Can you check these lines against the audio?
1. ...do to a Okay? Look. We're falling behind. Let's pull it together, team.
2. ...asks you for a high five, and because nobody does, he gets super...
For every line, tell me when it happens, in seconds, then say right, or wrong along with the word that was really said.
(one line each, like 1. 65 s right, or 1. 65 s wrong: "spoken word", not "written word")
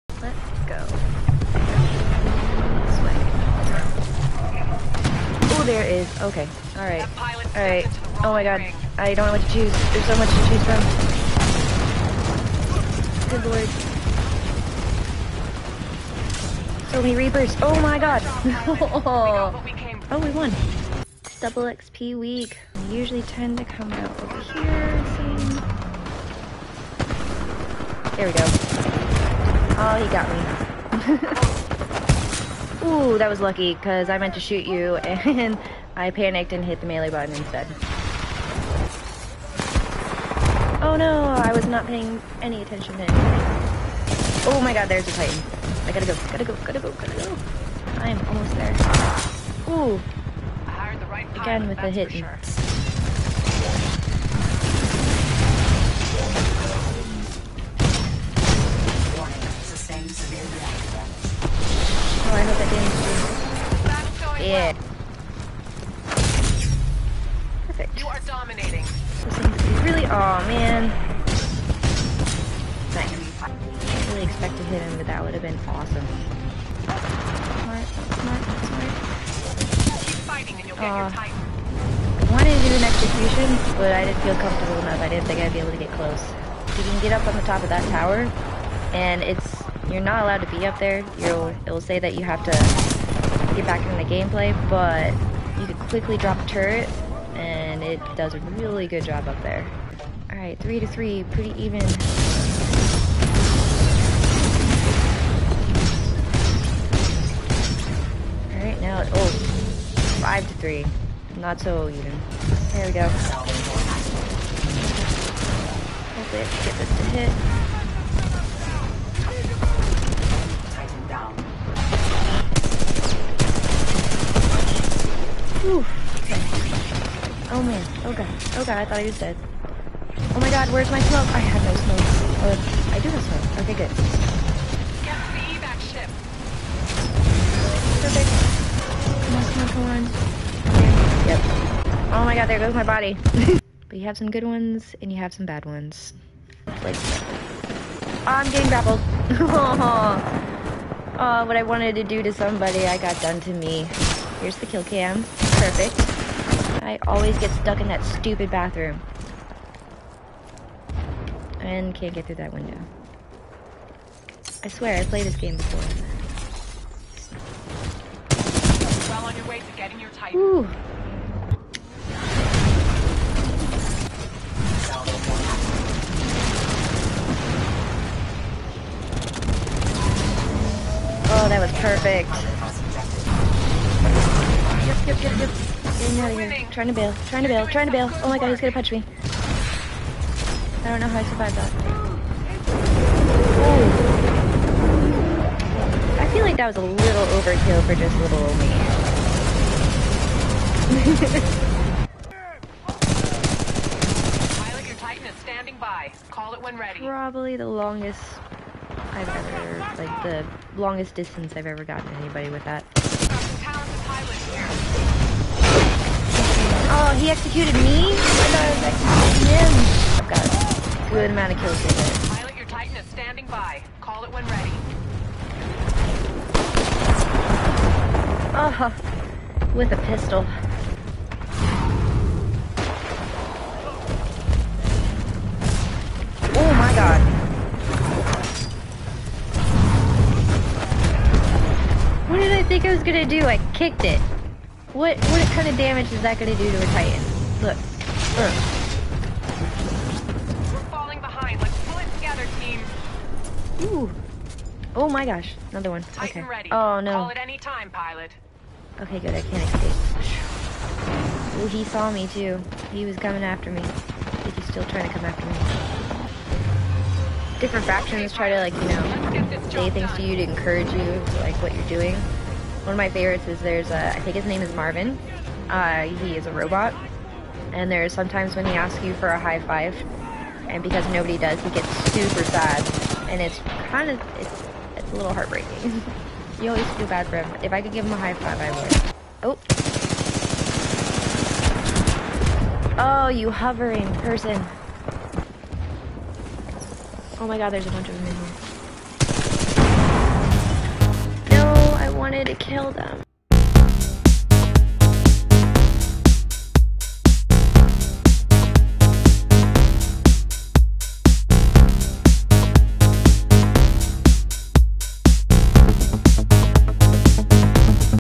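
1. 246 s wrong: "Titan", not "Okay"
2. 278 s right.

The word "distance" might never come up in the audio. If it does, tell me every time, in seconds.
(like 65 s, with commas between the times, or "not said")
211 s.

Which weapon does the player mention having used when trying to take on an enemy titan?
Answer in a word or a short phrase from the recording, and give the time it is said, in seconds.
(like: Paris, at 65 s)
pistol, at 230 s.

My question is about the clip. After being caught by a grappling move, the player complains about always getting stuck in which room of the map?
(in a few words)
bathroom.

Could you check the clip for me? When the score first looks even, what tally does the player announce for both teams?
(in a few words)
3 to 3.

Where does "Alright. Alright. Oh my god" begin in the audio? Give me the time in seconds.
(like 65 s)
6 s.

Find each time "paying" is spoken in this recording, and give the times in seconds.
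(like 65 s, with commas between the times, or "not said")
41 s.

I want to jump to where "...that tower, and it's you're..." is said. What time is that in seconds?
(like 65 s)
87 s.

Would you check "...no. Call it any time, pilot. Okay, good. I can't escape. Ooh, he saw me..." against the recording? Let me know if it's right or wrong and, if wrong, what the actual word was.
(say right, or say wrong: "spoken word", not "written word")
right.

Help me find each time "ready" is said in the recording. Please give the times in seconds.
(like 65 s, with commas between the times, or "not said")
206 s, 224 s, 256 s.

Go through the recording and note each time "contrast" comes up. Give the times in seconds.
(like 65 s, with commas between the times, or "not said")
not said.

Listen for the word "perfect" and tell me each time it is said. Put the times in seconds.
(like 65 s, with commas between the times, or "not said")
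64 s, 138 s, 155 s, 181 s.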